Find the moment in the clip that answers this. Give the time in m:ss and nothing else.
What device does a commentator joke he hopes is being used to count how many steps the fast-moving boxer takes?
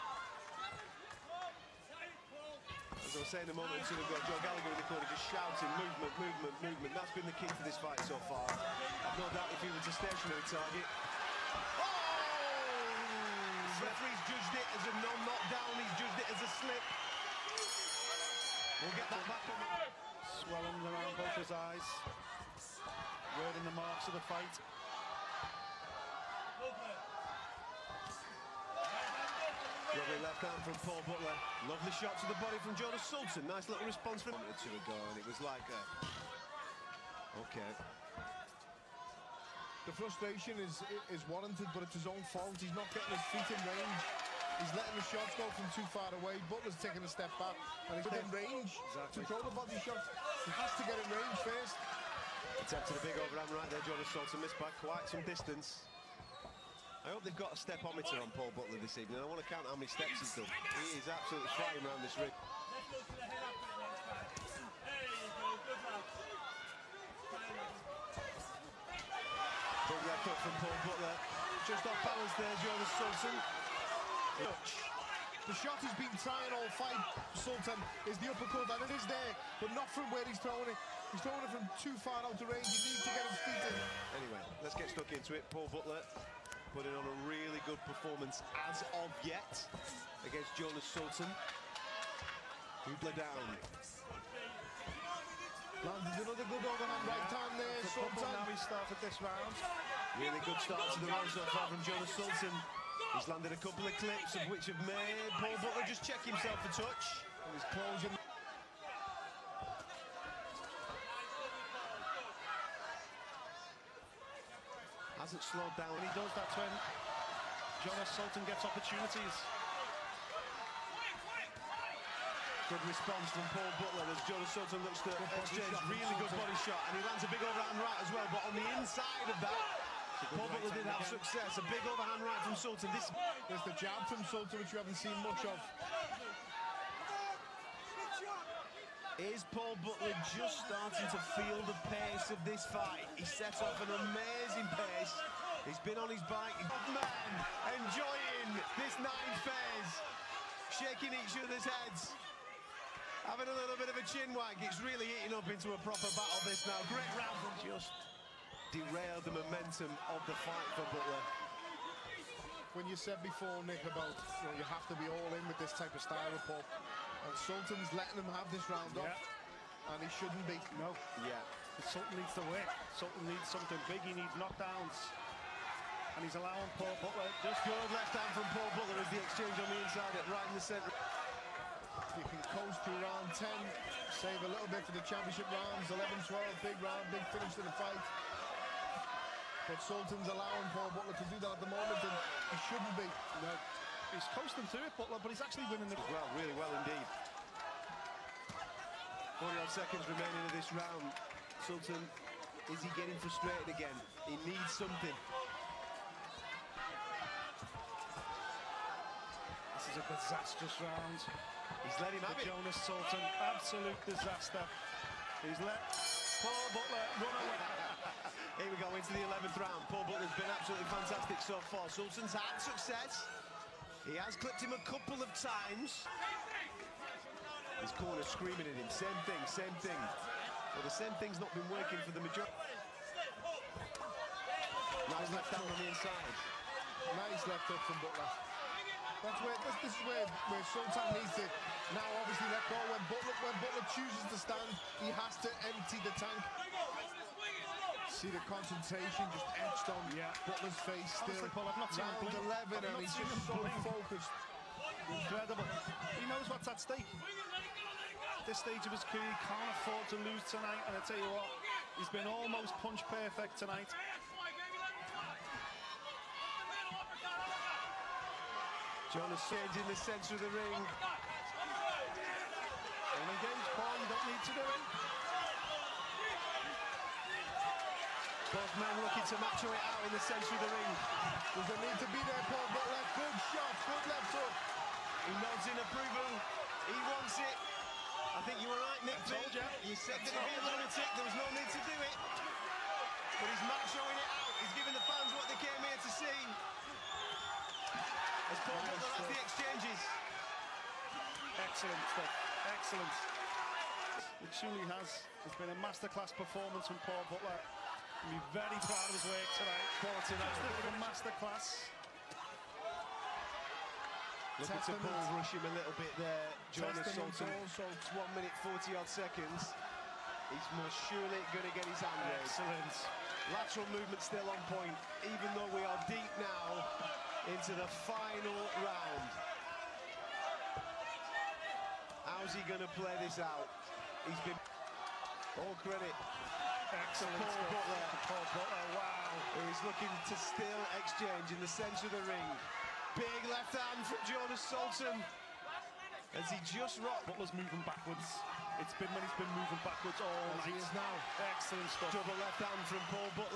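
0:57.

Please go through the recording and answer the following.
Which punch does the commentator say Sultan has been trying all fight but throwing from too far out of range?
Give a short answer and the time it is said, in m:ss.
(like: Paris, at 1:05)
uppercut, at 1:18.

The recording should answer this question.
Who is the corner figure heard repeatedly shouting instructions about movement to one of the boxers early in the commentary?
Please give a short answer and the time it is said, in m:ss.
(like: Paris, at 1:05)
Joe Gallagher, at 0:04.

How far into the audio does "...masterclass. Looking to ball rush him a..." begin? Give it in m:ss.
5:11.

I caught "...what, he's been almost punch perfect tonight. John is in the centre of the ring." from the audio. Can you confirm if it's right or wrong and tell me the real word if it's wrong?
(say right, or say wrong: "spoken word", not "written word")
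right.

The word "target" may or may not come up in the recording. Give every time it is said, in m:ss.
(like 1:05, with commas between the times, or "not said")
0:10.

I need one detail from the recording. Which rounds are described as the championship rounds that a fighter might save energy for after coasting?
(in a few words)
11-12.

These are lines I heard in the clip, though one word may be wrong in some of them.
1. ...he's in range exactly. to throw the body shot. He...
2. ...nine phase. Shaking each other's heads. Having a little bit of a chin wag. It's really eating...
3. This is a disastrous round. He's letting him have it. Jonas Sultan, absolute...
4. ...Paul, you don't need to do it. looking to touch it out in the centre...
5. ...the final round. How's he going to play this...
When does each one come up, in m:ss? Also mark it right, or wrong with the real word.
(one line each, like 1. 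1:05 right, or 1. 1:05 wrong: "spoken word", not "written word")
1. 0:47 right
2. 2:28 right
3. 3:29 right
4. 4:33 wrong: "match", not "touch"
5. 5:27 right.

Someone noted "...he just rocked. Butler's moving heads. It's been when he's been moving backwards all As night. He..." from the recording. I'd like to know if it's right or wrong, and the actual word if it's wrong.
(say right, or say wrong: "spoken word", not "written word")
wrong: "backwards", not "heads".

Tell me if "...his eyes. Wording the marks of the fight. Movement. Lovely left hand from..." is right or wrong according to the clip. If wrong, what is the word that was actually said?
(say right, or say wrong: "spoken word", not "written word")
right.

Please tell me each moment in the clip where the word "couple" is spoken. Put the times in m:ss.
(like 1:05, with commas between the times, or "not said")
1:43, 3:44.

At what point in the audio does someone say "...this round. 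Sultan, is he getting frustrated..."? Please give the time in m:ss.
3:20.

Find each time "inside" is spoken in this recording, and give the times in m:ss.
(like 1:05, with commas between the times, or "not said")
2:08, 2:59, 3:55.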